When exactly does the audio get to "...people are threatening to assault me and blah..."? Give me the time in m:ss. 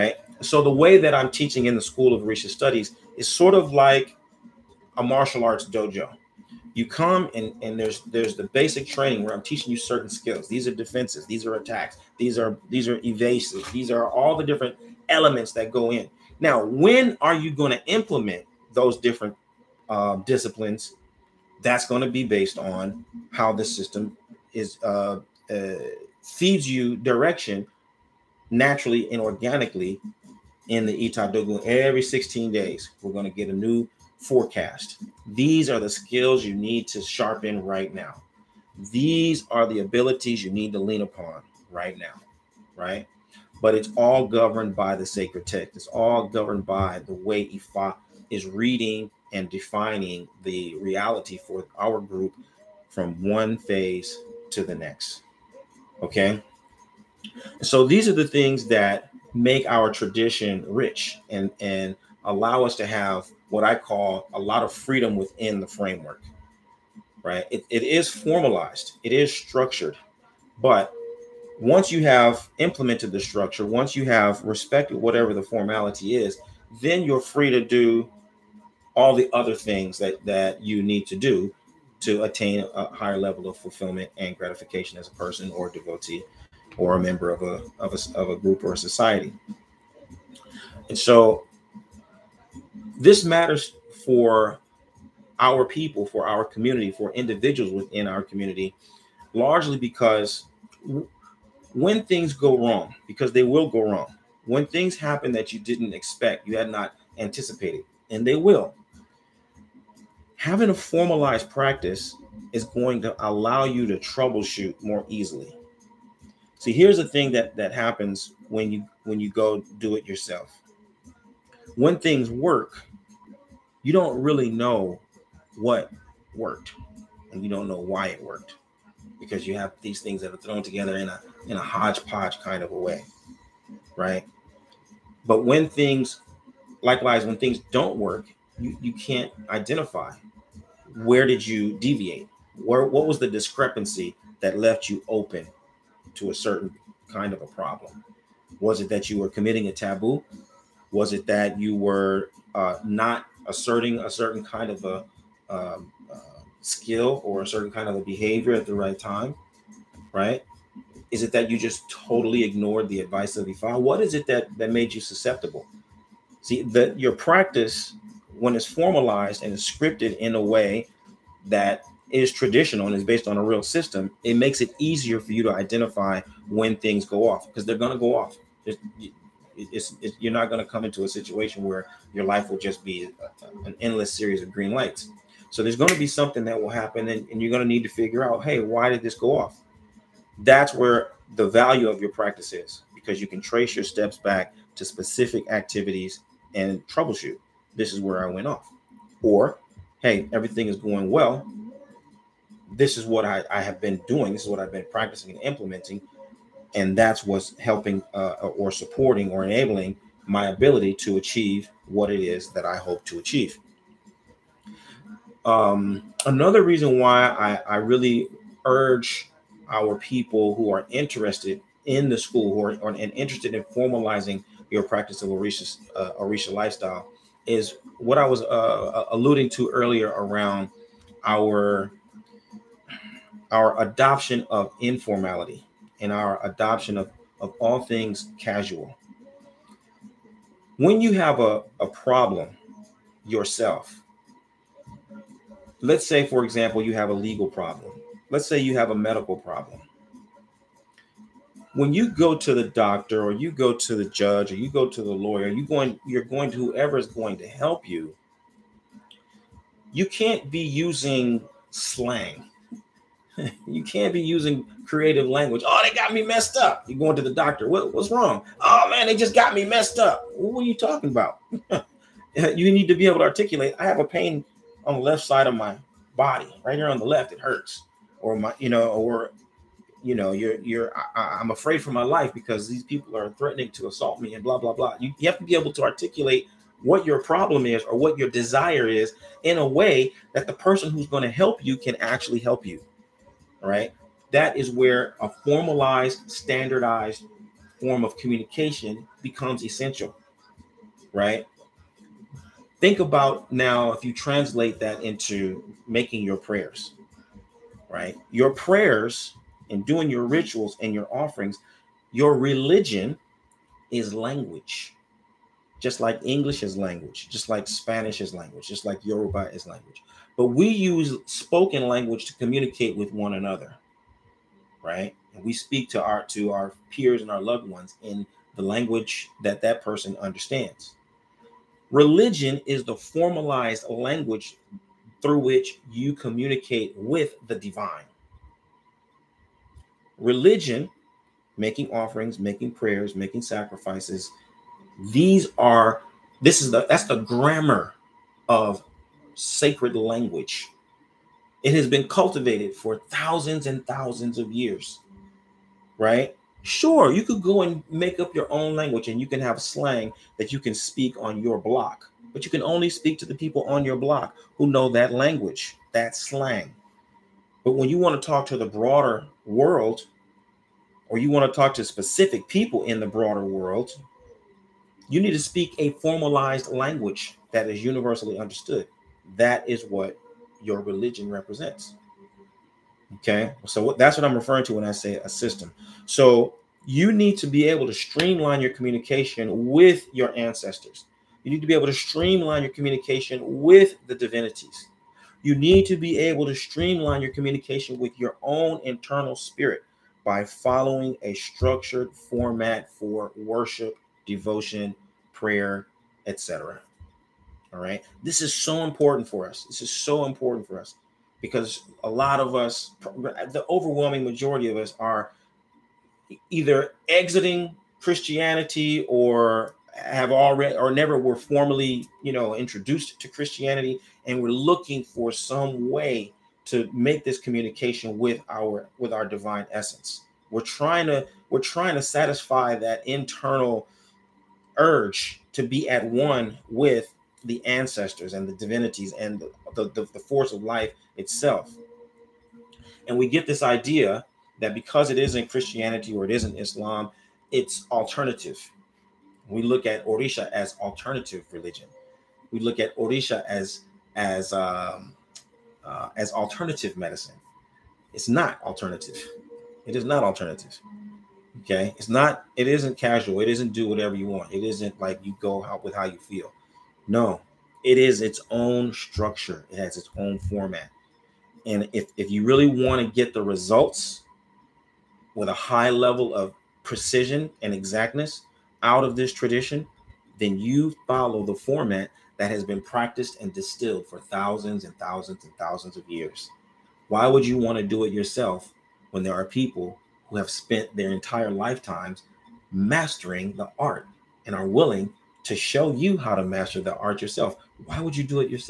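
4:42.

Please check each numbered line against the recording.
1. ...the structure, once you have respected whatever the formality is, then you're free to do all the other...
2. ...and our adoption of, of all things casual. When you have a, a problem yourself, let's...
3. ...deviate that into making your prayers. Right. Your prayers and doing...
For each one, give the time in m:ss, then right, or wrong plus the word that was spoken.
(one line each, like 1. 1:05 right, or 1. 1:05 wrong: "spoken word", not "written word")
1. 1:13 right
2. 3:56 right
3. 5:04 wrong: "translate", not "deviate".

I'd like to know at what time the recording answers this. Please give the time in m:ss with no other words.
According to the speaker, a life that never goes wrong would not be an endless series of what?
3:04.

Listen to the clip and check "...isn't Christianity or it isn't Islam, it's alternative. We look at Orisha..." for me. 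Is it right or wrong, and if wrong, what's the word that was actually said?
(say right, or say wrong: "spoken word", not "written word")
right.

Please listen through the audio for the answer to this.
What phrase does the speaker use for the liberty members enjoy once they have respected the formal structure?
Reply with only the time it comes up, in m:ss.
1:04.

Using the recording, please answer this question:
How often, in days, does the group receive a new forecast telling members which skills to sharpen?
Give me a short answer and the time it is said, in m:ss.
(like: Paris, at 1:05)
16, at 0:32.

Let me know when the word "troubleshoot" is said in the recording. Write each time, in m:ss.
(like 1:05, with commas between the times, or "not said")
1:53, 3:16.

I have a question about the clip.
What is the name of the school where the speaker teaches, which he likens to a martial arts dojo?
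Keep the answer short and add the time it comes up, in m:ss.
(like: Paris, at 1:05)
School of Orisha Studies, at 0:01.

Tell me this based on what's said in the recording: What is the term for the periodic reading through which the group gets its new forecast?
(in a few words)
Itadogu.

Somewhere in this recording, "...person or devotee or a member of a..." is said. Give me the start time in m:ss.
1:25.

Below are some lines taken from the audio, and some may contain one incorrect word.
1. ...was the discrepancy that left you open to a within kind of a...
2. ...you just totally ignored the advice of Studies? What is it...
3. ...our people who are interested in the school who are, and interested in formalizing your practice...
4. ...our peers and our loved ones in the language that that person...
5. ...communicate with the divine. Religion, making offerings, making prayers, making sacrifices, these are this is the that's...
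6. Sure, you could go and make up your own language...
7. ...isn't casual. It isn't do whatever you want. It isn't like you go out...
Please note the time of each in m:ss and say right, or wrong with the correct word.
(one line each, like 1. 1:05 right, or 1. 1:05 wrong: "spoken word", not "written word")
1. 2:23 wrong: "certain", not "within"
2. 2:41 wrong: "Ifa", not "Studies"
3. 3:39 right
4. 5:26 right
5. 5:36 right
6. 5:56 right
7. 7:42 right.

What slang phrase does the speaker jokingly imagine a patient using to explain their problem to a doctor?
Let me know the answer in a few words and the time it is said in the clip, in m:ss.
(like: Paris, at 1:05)
they got me messed up, at 4:25.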